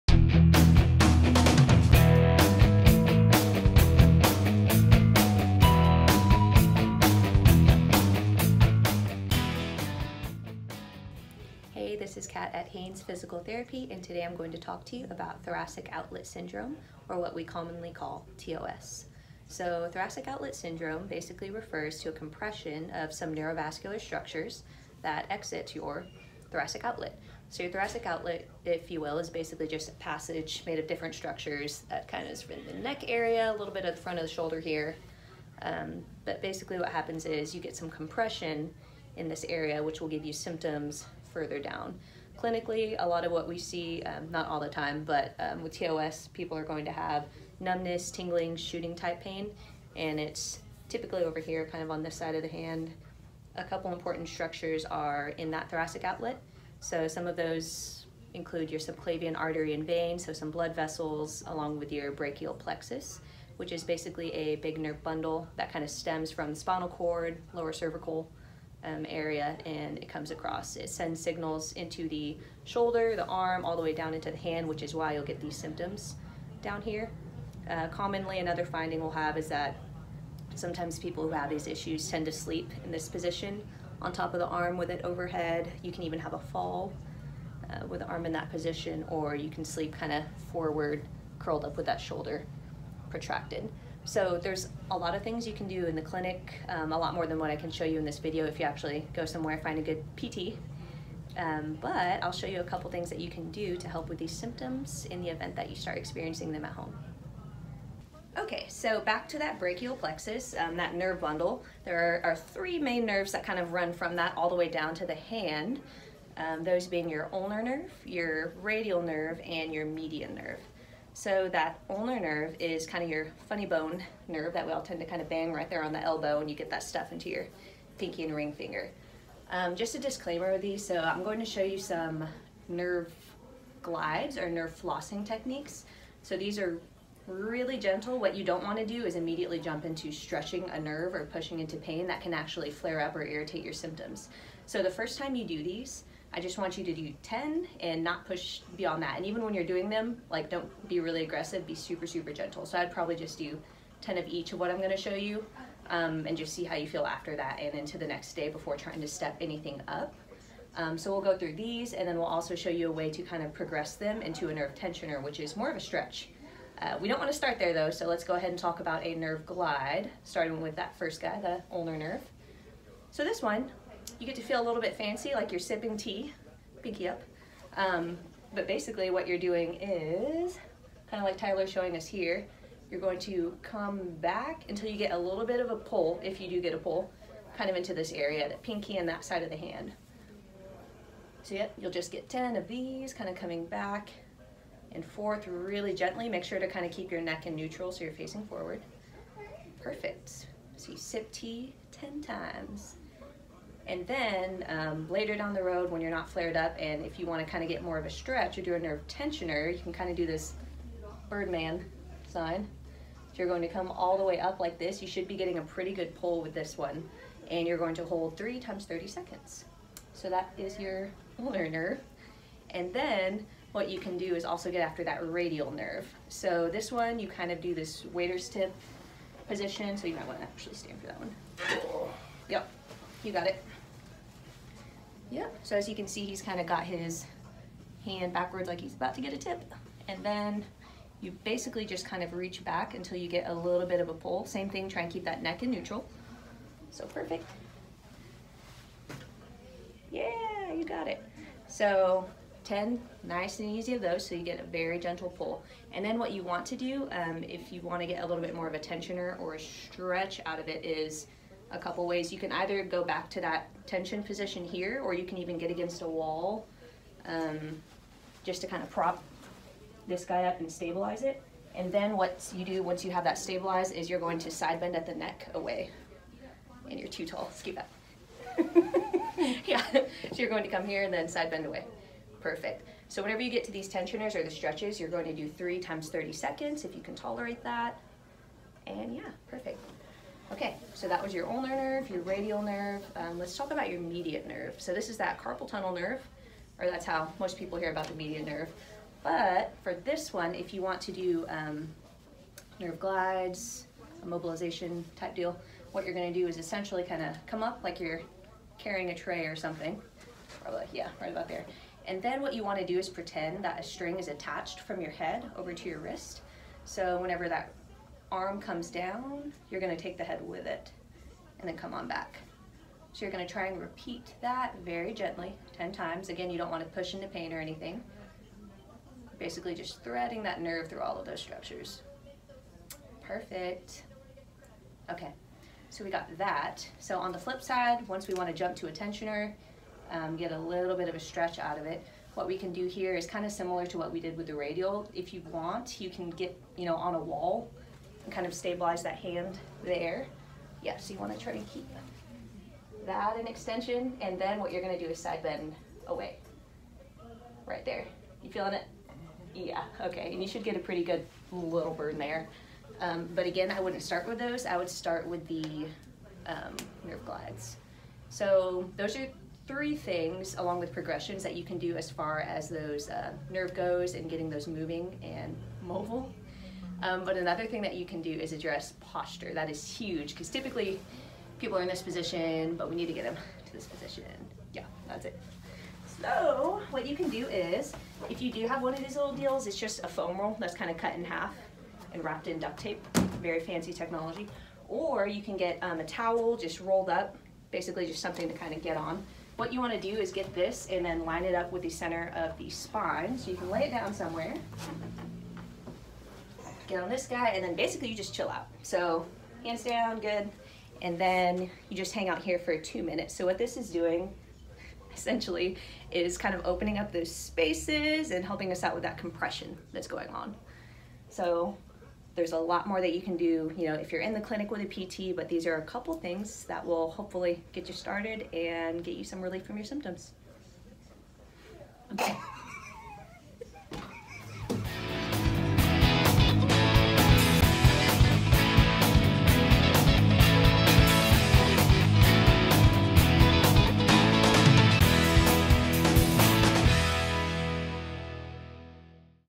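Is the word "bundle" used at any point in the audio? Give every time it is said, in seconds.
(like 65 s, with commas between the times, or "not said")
65 s, 111 s.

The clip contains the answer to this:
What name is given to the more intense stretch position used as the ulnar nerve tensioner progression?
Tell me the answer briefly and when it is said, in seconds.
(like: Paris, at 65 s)
Birdman sign, at 211 s.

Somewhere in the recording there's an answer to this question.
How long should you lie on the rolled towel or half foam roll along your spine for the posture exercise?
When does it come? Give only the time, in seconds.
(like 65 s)
412 s.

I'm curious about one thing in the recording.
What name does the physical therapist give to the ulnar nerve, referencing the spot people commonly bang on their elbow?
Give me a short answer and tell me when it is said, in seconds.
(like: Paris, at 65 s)
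funny bone nerve, at 123 s.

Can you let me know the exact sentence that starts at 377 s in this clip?
Um, but another thing that you can do is address posture.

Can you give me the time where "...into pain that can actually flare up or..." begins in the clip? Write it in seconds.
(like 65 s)
141 s.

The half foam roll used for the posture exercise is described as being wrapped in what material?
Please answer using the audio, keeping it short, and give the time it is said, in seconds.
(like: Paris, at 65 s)
duct tape, at 392 s.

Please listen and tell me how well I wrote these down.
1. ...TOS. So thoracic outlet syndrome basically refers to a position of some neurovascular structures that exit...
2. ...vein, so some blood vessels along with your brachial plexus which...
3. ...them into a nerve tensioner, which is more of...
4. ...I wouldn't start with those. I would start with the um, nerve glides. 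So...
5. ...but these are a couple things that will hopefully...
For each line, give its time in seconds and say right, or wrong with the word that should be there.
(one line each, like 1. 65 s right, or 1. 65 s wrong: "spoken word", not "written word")
1. 18 s wrong: "compression", not "position"
2. 59 s right
3. 163 s right
4. 363 s right
5. 425 s right.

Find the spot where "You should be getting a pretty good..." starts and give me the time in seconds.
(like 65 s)
215 s.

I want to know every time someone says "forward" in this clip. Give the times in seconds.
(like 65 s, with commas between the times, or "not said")
90 s, 198 s.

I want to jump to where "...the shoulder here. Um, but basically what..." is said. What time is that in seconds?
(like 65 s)
34 s.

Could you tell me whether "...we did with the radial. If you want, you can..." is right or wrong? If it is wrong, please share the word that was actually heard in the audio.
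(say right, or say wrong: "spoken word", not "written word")
right.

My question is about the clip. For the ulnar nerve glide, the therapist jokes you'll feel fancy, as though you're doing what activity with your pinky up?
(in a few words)
sipping tea.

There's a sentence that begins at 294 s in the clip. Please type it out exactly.
So this is that carpal tunnel nerve, or that's how most people hear about the median nerve.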